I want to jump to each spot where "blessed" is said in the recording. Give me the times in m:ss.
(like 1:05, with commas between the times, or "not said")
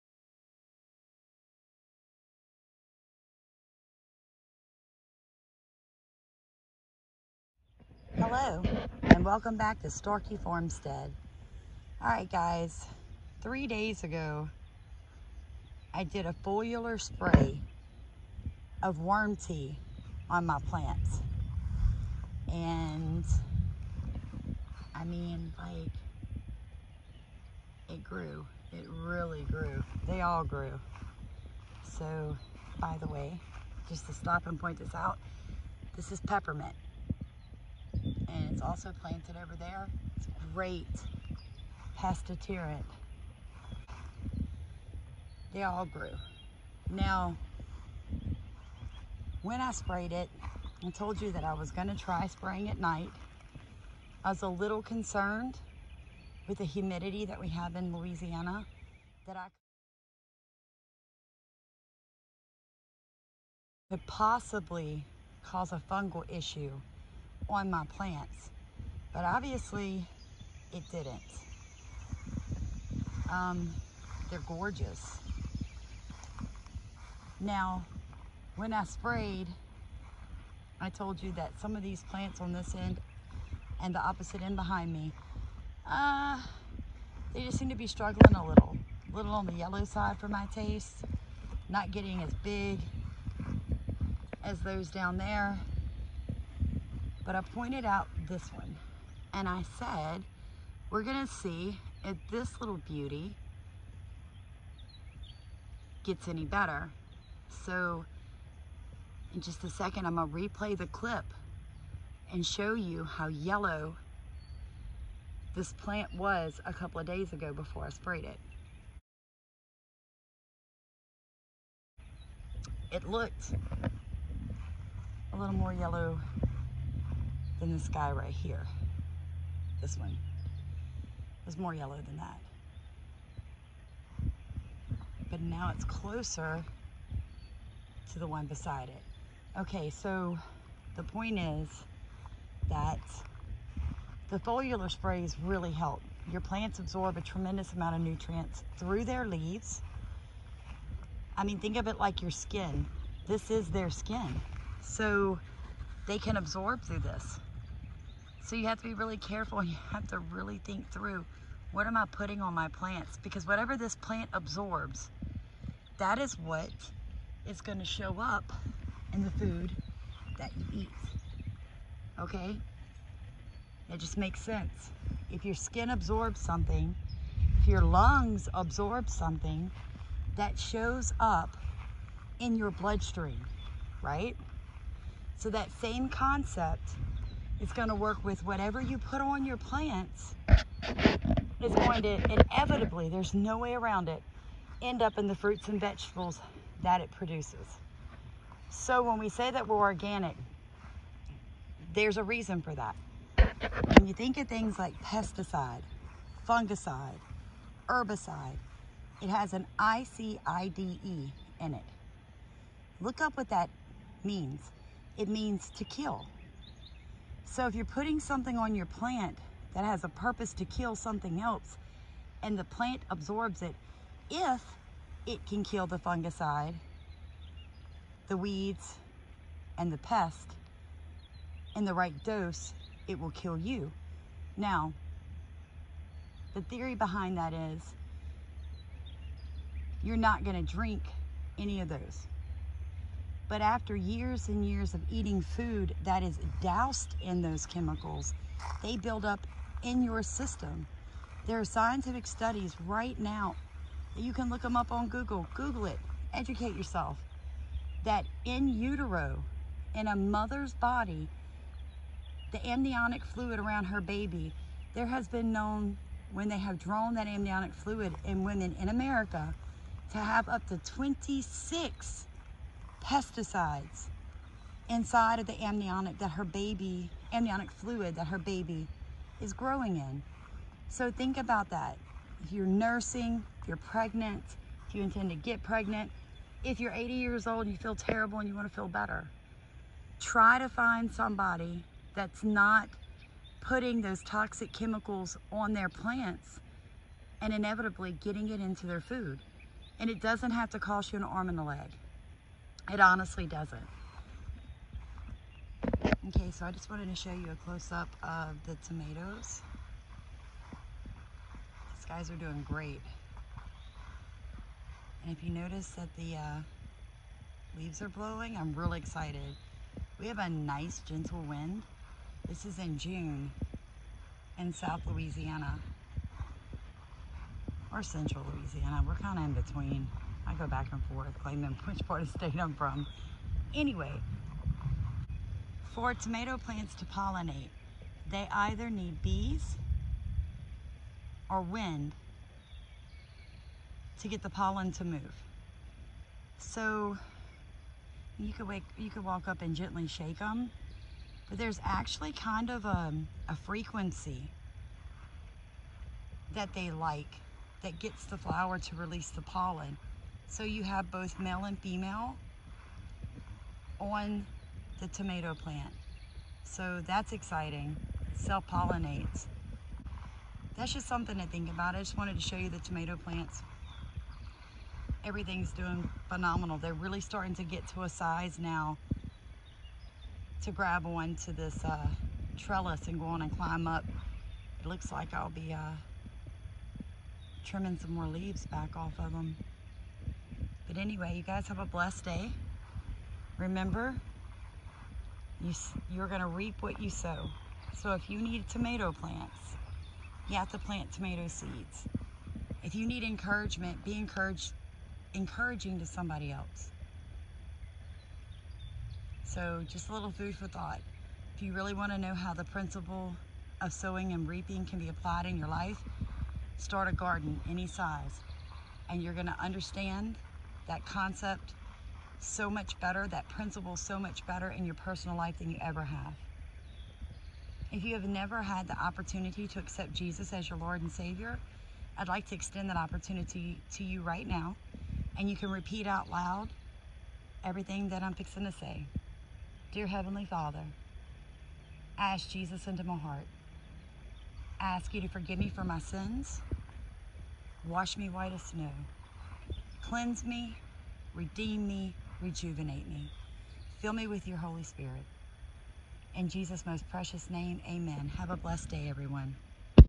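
6:31, 7:38.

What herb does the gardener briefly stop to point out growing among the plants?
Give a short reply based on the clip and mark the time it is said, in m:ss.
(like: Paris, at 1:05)
Peppermint, at 0:36.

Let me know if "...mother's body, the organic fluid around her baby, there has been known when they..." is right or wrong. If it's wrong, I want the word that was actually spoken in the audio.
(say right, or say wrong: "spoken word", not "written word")
wrong: "amniotic", not "organic".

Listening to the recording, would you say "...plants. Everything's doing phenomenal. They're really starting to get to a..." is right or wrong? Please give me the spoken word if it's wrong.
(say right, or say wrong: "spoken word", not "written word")
right.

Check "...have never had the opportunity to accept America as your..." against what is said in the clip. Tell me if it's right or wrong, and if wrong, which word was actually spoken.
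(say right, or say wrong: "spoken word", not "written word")
wrong: "Jesus", not "America".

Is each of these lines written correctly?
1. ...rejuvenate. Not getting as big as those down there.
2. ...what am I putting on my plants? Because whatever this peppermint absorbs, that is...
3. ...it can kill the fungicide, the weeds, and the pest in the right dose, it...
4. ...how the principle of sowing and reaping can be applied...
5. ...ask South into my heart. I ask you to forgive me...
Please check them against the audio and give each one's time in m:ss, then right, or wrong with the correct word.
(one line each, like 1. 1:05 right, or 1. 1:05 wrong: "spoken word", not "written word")
1. 1:30 wrong: "taste", not "rejuvenate"
2. 2:41 wrong: "plant", not "peppermint"
3. 3:45 right
4. 6:52 right
5. 7:22 wrong: "Jesus", not "South".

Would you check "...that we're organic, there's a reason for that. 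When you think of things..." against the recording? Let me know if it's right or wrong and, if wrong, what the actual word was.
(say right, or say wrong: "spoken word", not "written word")
right.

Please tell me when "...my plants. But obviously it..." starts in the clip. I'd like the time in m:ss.
1:07.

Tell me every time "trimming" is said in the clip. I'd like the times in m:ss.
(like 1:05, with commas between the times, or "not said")
6:27.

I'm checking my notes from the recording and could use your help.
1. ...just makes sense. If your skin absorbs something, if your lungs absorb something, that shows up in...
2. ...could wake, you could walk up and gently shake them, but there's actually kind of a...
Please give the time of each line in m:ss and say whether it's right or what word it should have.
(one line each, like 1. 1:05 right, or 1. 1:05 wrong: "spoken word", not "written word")
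1. 2:54 right
2. 5:48 right.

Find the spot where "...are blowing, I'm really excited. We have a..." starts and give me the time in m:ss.
5:18.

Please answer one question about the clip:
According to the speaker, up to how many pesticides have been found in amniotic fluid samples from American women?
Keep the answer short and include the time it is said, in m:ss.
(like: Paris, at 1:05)
26, at 4:30.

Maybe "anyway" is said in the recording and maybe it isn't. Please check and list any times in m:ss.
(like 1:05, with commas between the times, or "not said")
5:33, 6:30.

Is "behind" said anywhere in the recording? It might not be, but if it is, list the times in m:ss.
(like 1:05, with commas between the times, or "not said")
1:24, 3:56.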